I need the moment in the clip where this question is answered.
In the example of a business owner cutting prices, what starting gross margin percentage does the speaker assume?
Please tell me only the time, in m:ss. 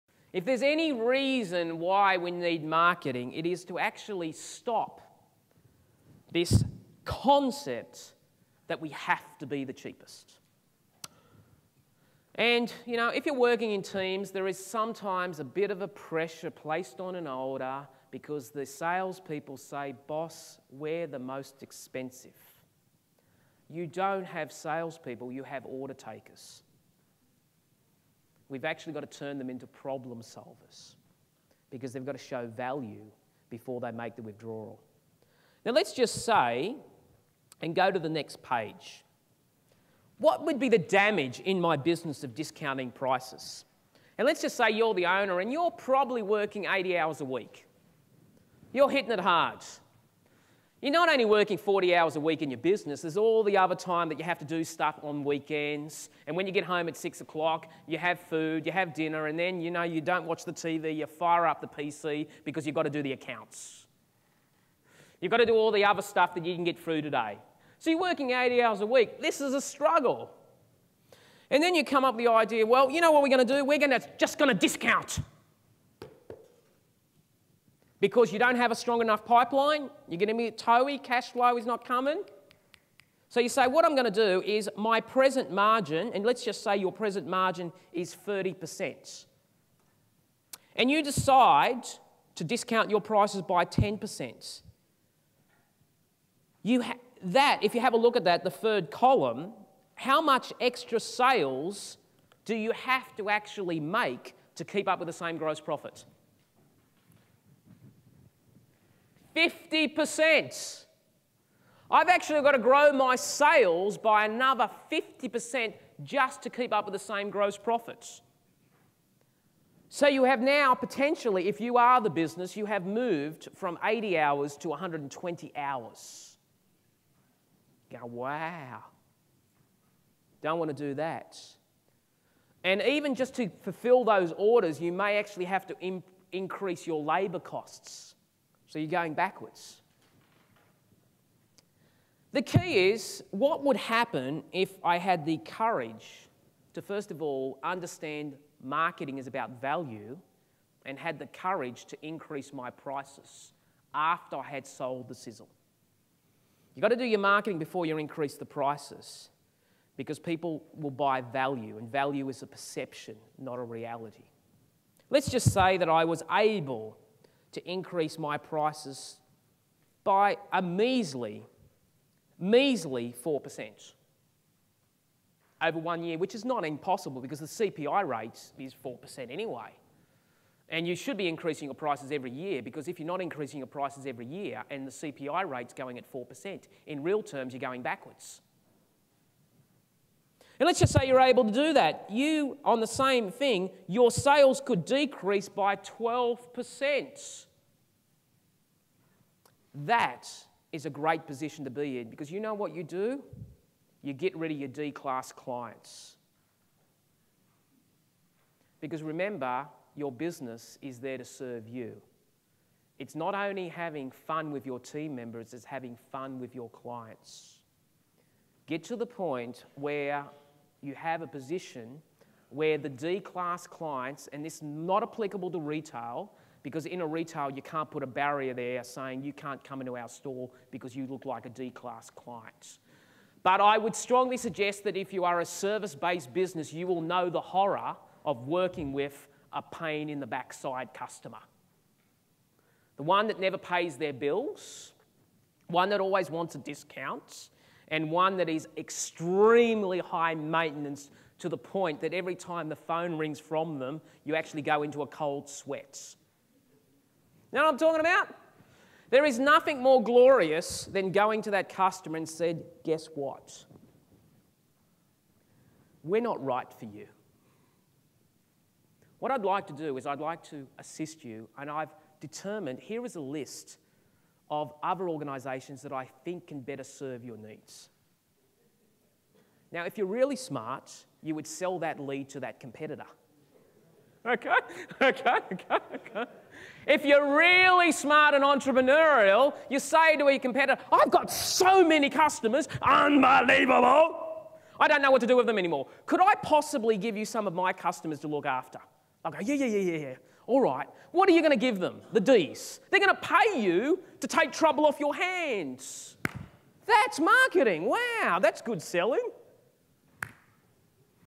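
1:28.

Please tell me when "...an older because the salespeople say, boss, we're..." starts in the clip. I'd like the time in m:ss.
0:17.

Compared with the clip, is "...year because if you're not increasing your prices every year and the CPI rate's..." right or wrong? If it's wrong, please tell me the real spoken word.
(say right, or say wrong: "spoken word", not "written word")
right.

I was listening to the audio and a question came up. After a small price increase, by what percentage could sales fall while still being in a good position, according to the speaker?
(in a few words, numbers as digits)
12%.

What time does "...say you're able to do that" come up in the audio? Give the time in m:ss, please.
3:10.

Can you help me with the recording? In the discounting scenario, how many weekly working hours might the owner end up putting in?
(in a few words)
120 hours.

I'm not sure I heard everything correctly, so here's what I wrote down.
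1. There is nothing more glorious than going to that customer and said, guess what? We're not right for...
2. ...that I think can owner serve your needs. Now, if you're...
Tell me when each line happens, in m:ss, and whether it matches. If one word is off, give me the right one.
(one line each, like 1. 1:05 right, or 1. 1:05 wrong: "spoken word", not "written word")
1. 4:19 right
2. 4:35 wrong: "better", not "owner".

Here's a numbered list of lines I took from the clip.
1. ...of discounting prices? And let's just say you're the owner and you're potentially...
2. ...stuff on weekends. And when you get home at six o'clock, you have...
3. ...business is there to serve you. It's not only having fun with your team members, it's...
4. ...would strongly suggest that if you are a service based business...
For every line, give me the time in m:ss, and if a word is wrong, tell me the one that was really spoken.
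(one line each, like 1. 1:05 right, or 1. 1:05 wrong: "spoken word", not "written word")
1. 0:42 wrong: "probably", not "potentially"
2. 0:54 right
3. 3:30 right
4. 3:53 right.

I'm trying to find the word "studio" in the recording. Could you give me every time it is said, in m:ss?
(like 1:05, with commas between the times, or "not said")
not said.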